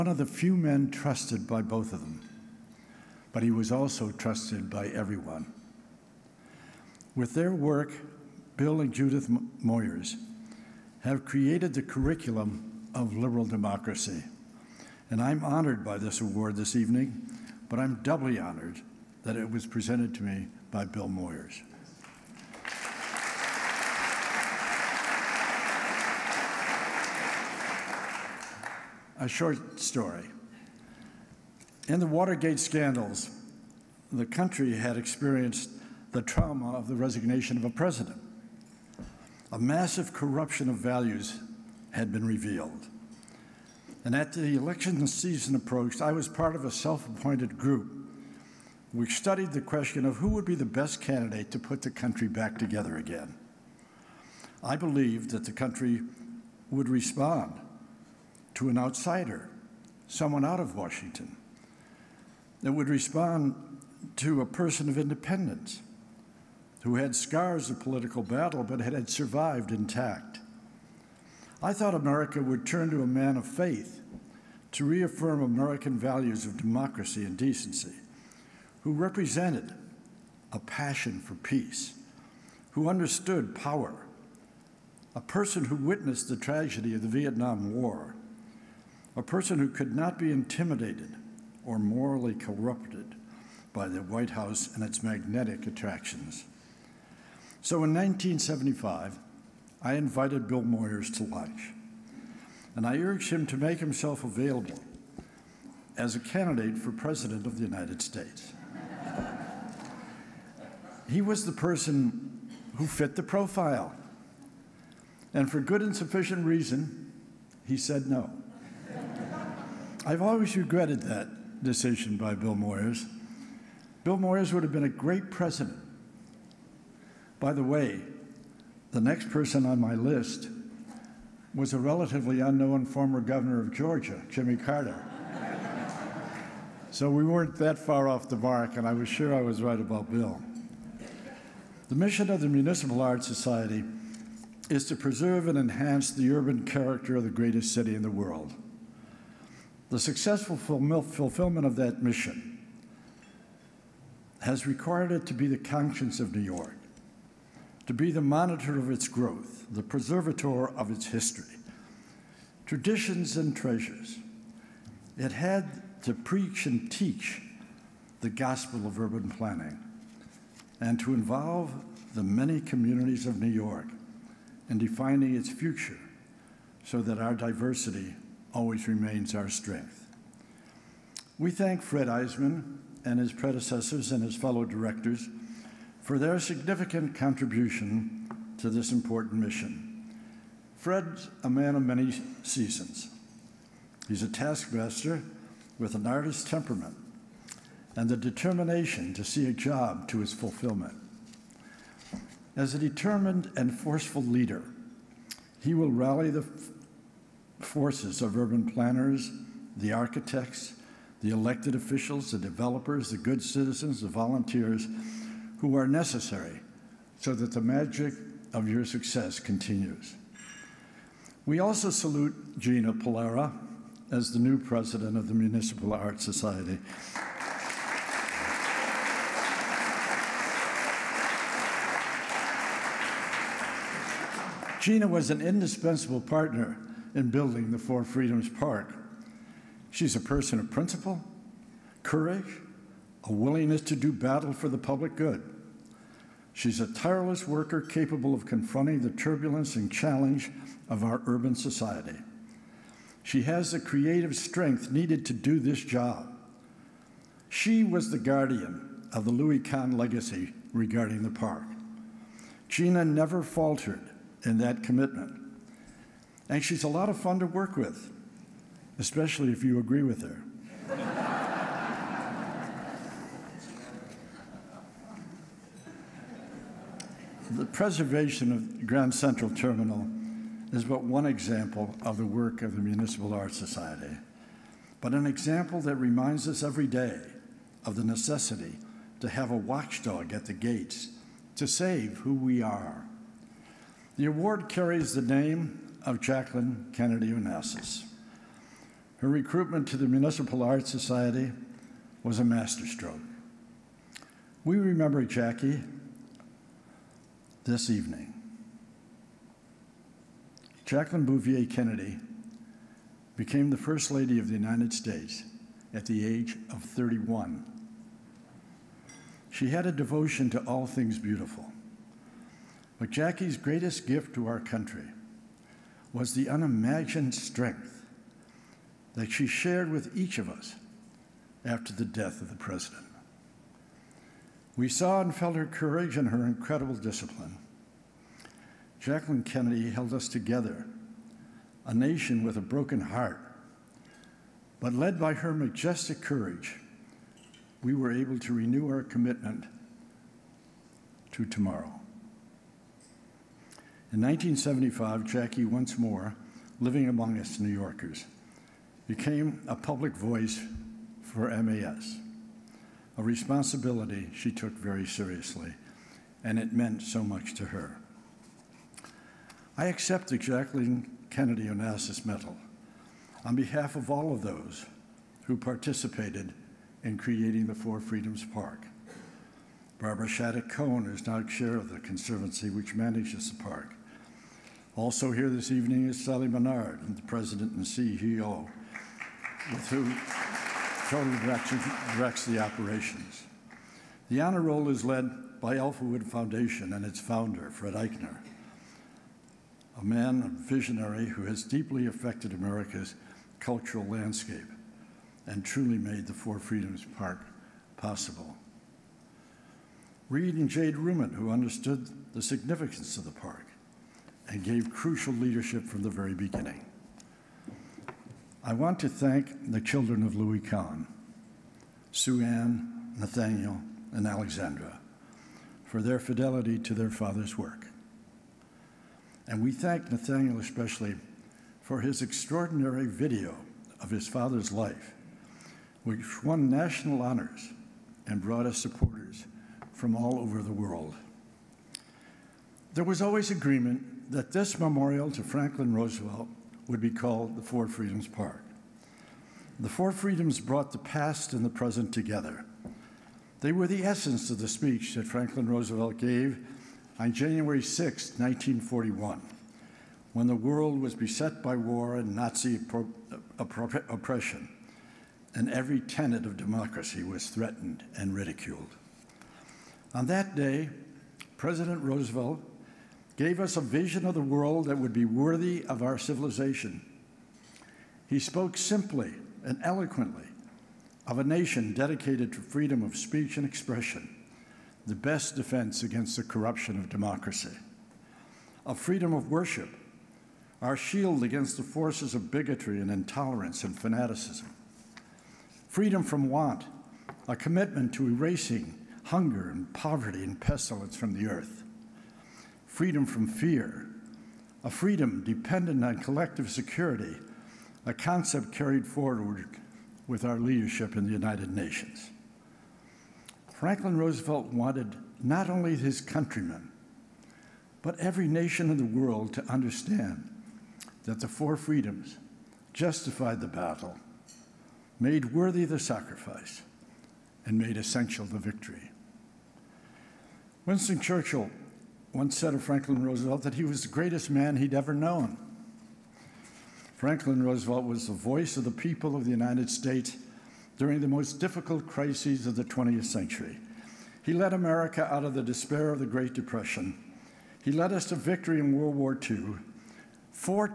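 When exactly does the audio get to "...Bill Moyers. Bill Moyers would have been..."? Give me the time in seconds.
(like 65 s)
122 s.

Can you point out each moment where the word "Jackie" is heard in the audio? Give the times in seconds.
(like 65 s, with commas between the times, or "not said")
305 s, 323 s, 355 s.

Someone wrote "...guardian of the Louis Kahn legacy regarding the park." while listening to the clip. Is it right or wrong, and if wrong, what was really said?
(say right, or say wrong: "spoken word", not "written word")
right.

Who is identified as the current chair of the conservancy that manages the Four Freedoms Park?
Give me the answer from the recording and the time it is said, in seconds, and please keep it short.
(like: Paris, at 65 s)
Barbara Shattuck Kohn, at 379 s.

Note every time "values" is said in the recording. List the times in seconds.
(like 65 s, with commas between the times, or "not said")
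40 s, 75 s.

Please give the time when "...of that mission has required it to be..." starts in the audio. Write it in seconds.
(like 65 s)
151 s.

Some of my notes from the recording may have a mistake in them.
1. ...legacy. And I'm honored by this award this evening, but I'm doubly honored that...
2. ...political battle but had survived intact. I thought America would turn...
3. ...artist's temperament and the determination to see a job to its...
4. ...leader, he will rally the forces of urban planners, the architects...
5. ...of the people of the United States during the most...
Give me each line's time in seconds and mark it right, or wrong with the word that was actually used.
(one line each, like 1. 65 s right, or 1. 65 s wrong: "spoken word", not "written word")
1. 13 s wrong: "democracy", not "legacy"
2. 67 s right
3. 196 s right
4. 204 s right
5. 538 s right.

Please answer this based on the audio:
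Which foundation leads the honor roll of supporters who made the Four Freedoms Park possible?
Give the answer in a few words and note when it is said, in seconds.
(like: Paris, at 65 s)
Alpha Wood Foundation, at 395 s.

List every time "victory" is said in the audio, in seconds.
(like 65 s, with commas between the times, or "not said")
528 s, 548 s.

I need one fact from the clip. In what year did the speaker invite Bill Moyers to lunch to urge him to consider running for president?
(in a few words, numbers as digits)
1975.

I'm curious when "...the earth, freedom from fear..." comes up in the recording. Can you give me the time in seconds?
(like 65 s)
501 s.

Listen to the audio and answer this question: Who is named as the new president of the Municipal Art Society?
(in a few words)
Gina Pollara.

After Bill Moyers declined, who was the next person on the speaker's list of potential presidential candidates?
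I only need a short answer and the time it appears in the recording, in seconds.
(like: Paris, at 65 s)
Jimmy Carter, at 134 s.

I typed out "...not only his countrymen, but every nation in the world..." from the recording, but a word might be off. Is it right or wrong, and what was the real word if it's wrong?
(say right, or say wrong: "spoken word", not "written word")
right.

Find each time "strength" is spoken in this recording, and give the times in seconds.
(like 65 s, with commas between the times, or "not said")
179 s, 254 s, 327 s.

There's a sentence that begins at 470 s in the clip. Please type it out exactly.
On that day, President Roosevelt gave us a vision of the world that would be worthy of our civilization.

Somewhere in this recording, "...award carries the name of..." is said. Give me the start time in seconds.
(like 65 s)
294 s.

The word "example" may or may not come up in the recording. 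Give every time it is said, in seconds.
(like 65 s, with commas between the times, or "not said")
281 s, 285 s.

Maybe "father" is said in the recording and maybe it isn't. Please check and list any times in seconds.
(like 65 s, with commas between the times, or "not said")
427 s, 434 s.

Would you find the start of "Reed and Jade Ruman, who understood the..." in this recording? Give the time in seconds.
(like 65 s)
410 s.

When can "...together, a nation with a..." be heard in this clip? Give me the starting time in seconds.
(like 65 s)
340 s.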